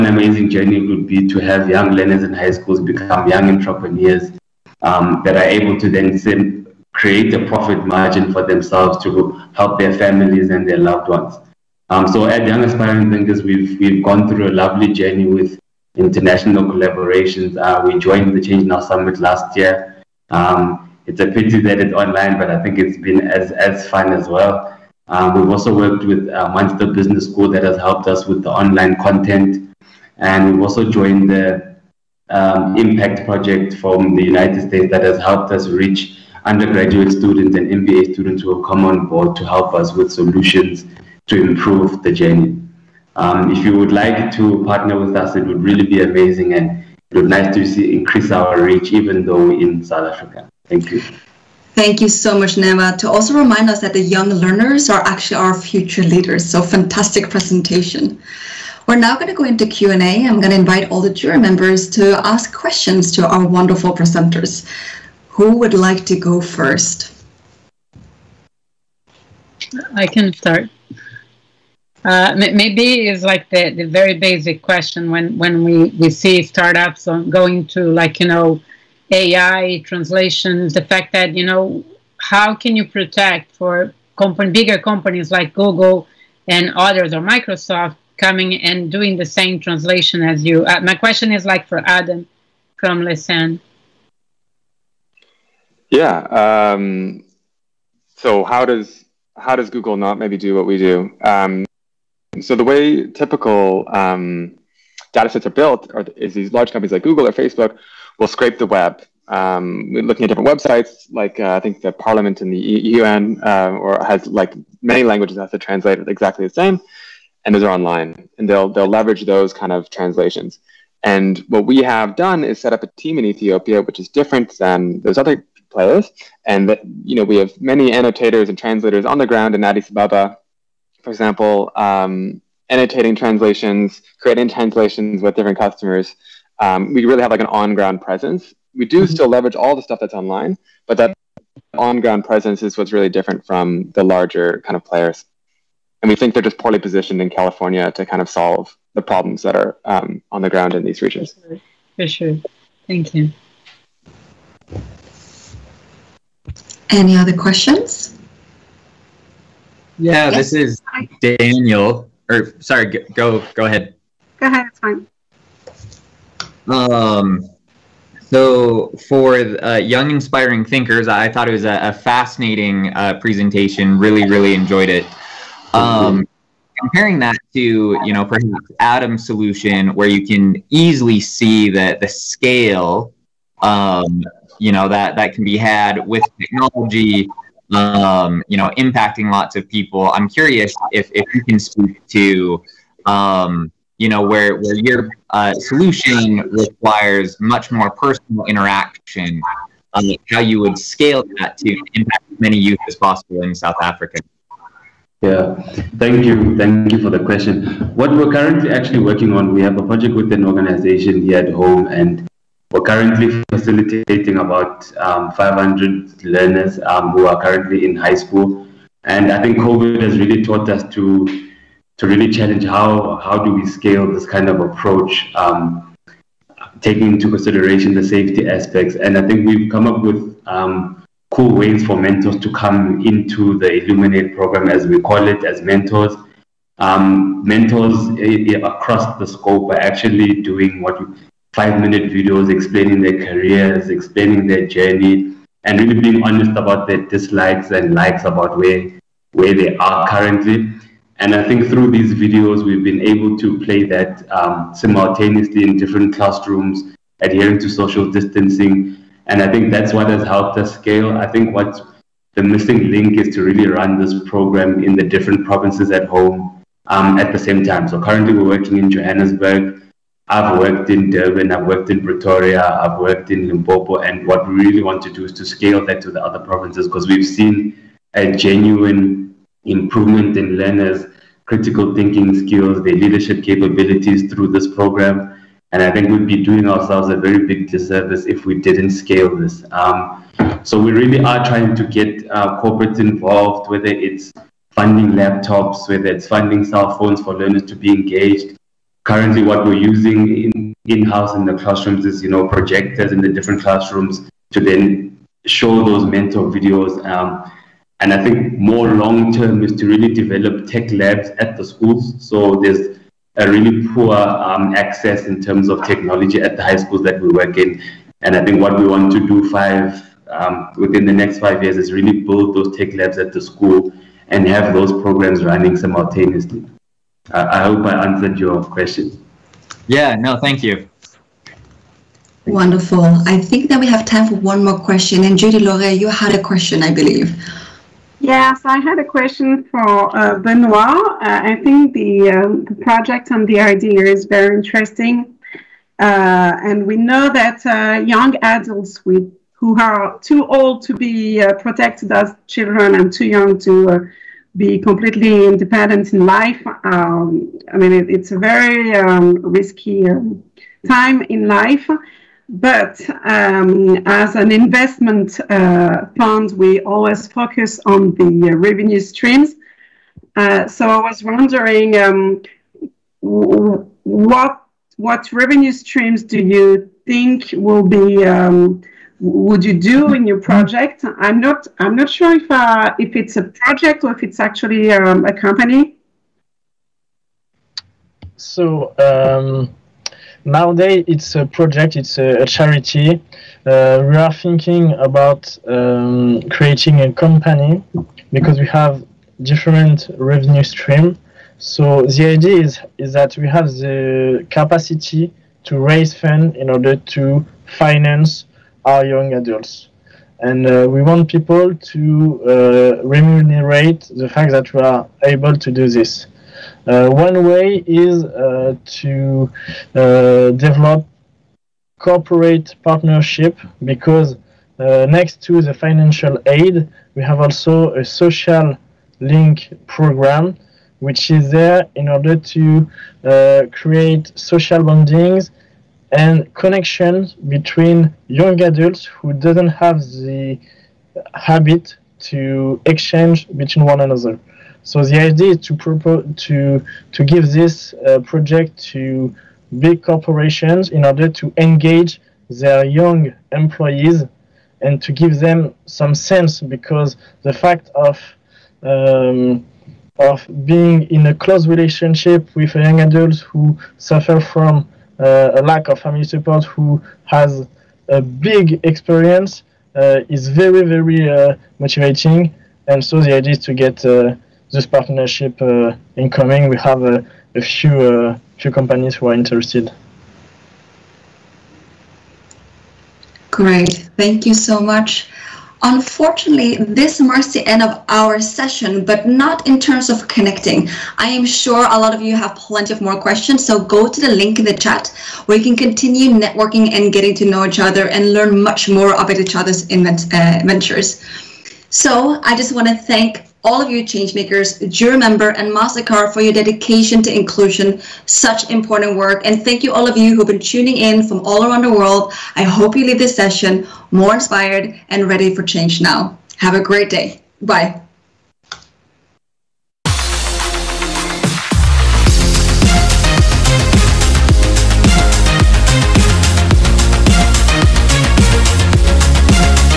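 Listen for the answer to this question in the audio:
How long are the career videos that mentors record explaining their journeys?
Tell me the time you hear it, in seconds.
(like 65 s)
241 s.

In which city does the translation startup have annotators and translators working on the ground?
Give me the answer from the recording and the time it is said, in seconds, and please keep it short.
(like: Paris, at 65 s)
Addis Ababa, at 129 s.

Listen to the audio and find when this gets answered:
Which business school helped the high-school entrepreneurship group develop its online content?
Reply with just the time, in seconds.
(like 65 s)
26 s.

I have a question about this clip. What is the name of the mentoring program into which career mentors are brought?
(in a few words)
Illuminate.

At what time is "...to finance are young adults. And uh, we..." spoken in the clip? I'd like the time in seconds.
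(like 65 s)
406 s.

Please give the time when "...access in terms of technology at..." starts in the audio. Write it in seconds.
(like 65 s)
314 s.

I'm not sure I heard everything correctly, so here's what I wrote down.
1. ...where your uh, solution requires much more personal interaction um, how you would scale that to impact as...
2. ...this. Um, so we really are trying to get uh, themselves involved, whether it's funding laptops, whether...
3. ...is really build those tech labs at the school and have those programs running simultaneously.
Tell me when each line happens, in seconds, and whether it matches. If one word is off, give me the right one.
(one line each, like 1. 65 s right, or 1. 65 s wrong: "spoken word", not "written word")
1. 194 s right
2. 289 s wrong: "corporates", not "themselves"
3. 321 s right.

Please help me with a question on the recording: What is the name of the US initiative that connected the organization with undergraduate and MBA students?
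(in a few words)
Impact Project.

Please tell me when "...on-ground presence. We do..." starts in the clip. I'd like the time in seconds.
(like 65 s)
137 s.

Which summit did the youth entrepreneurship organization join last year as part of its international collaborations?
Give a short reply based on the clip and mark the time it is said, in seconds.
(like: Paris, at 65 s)
Change Now Summit, at 18 s.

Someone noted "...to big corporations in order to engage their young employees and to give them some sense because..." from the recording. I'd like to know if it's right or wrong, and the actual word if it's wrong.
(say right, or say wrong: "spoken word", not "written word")
right.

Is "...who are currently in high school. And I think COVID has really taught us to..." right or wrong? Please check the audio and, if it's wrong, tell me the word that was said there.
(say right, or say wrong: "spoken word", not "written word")
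right.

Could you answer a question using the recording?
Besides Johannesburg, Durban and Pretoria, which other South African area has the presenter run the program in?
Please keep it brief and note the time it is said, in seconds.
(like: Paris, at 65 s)
Limpopo, at 273 s.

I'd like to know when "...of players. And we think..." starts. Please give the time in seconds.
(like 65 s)
144 s.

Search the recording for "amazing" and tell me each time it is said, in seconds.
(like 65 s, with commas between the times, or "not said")
0 s, 46 s.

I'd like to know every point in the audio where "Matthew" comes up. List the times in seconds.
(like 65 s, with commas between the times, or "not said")
not said.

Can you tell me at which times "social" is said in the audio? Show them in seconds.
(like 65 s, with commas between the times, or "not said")
257 s, 428 s, 434 s.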